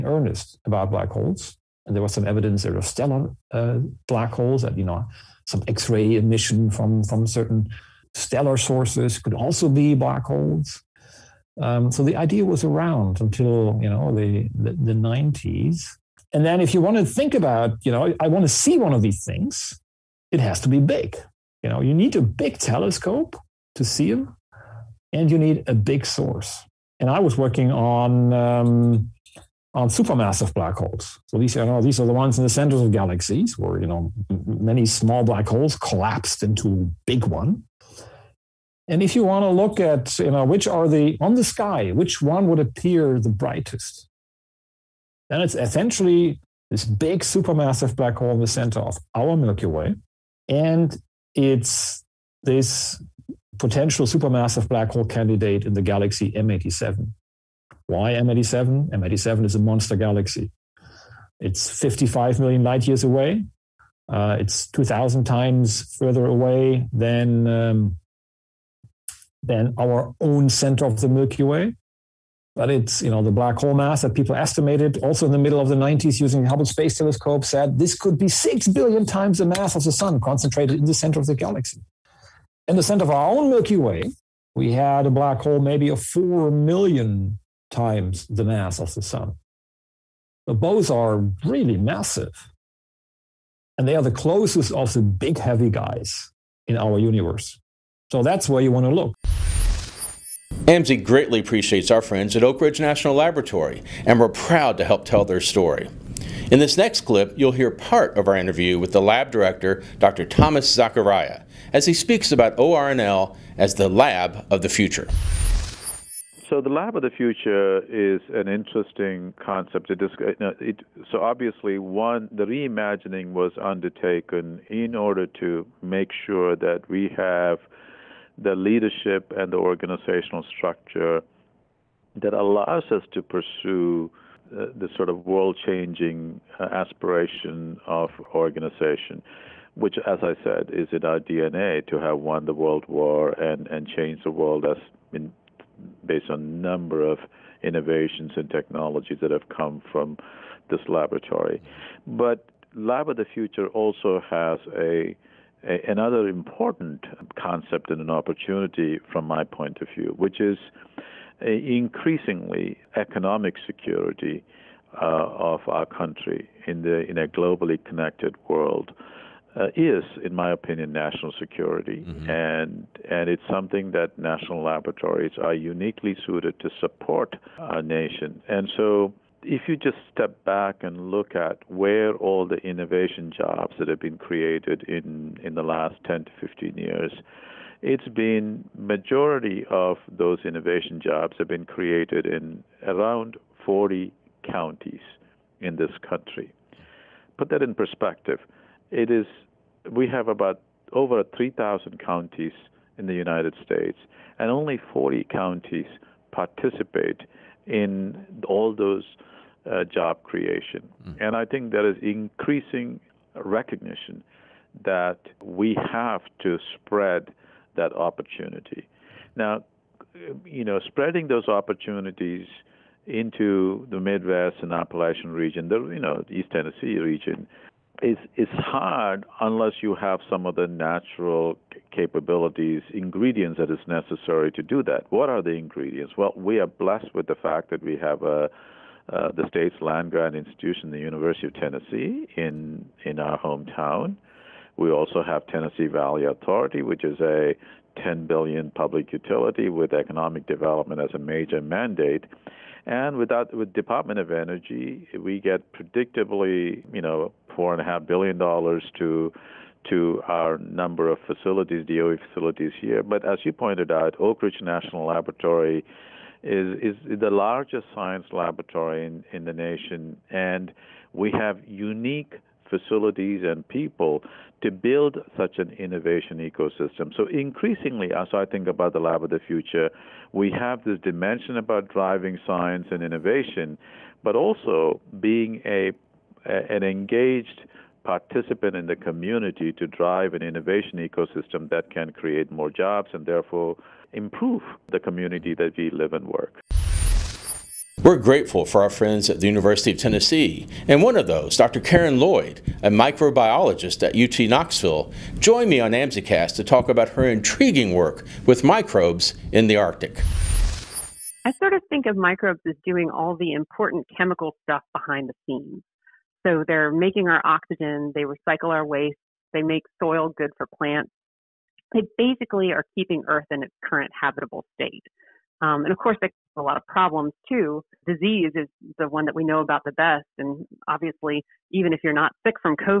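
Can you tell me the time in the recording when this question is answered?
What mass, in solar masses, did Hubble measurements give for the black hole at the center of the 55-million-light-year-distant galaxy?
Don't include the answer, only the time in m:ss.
1:18.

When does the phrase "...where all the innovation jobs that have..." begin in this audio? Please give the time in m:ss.
3:01.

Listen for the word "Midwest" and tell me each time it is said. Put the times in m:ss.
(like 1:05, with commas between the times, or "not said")
3:44.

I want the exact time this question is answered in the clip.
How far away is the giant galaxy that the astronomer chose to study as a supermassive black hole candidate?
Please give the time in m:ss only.
1:01.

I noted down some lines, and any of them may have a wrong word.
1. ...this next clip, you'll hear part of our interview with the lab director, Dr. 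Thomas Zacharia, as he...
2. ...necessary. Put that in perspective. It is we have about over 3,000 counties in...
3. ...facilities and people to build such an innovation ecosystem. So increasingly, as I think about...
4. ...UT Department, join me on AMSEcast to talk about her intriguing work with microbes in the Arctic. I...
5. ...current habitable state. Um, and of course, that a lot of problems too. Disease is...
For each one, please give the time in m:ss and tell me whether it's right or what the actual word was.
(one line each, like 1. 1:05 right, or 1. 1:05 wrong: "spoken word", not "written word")
1. 1:46 right
2. 3:16 wrong: "country", not "necessary"
3. 4:32 right
4. 5:04 wrong: "Knoxville", not "Department"
5. 5:23 right.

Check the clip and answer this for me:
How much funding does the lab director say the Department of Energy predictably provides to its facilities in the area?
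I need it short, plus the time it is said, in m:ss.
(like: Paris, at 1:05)
$4.5 billion, at 4:17.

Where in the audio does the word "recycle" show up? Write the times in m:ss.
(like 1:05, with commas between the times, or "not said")
5:18.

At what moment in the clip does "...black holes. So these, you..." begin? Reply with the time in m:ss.
0:30.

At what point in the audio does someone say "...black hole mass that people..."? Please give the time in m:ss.
1:13.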